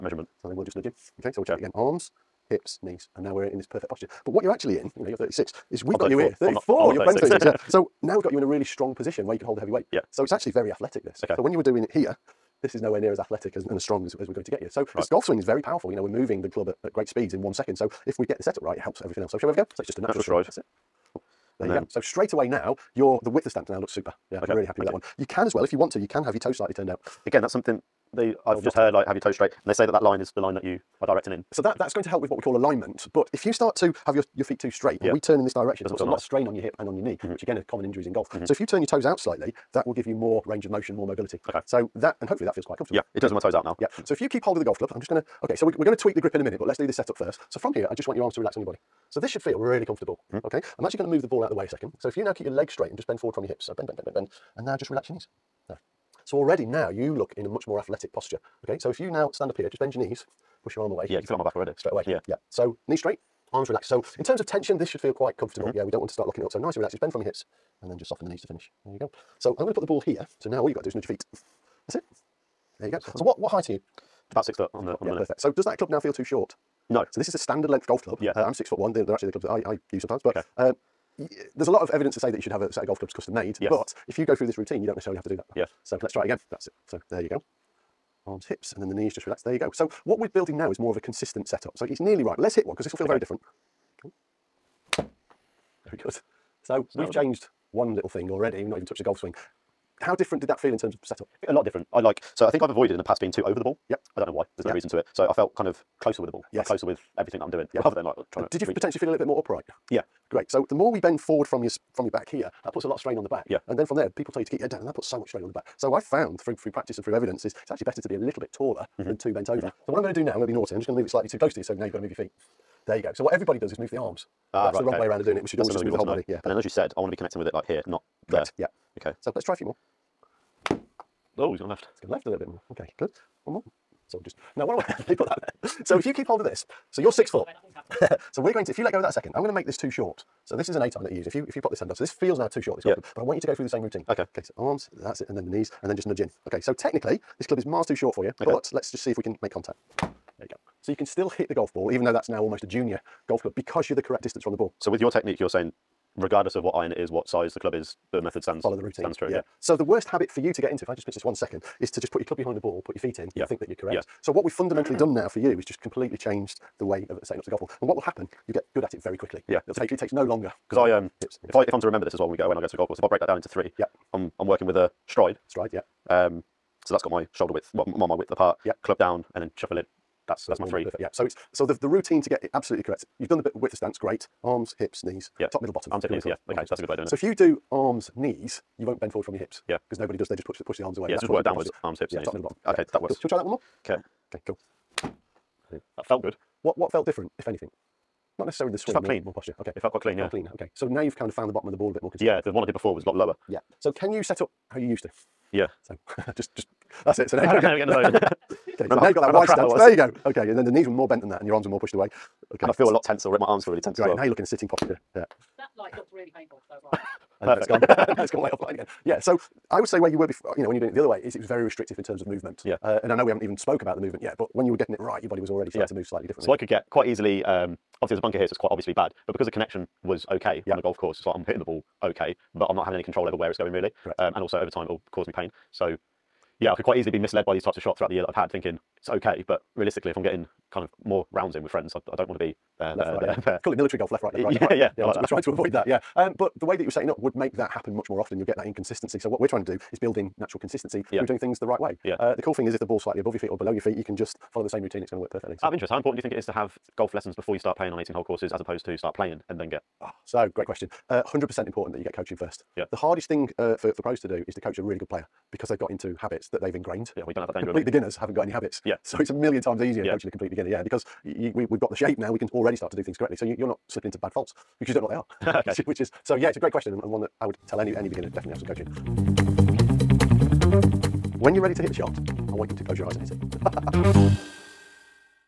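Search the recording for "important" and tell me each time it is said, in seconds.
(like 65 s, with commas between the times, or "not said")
255 s, 261 s.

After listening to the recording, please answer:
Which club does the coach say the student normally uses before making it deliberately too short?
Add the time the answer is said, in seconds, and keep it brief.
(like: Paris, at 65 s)
8 iron, at 140 s.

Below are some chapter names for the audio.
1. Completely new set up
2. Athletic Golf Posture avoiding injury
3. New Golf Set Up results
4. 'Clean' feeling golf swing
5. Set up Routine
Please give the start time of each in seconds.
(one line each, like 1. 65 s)
1. 167 s
2. 59 s
3. 102 s
4. 200 s
5. 182 s.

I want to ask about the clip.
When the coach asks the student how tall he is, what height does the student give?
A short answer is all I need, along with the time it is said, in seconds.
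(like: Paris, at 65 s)
About 6 foot, at 74 s.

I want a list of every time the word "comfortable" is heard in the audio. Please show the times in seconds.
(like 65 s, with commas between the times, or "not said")
42 s, 49 s, 65 s.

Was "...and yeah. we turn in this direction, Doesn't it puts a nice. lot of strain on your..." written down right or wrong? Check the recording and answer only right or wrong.
right.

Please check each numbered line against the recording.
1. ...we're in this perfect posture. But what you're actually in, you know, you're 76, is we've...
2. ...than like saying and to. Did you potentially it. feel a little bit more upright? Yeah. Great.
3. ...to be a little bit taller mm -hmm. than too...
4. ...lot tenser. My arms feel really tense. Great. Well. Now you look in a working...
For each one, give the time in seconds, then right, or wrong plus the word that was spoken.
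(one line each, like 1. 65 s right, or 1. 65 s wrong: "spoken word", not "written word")
1. 3 s wrong: "36", not "76"
2. 107 s wrong: "trying", not "saying"
3. 117 s right
4. 212 s wrong: "sitting", not "working".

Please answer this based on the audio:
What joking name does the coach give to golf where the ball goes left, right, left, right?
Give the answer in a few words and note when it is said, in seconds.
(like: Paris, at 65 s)
Military golf, at 243 s.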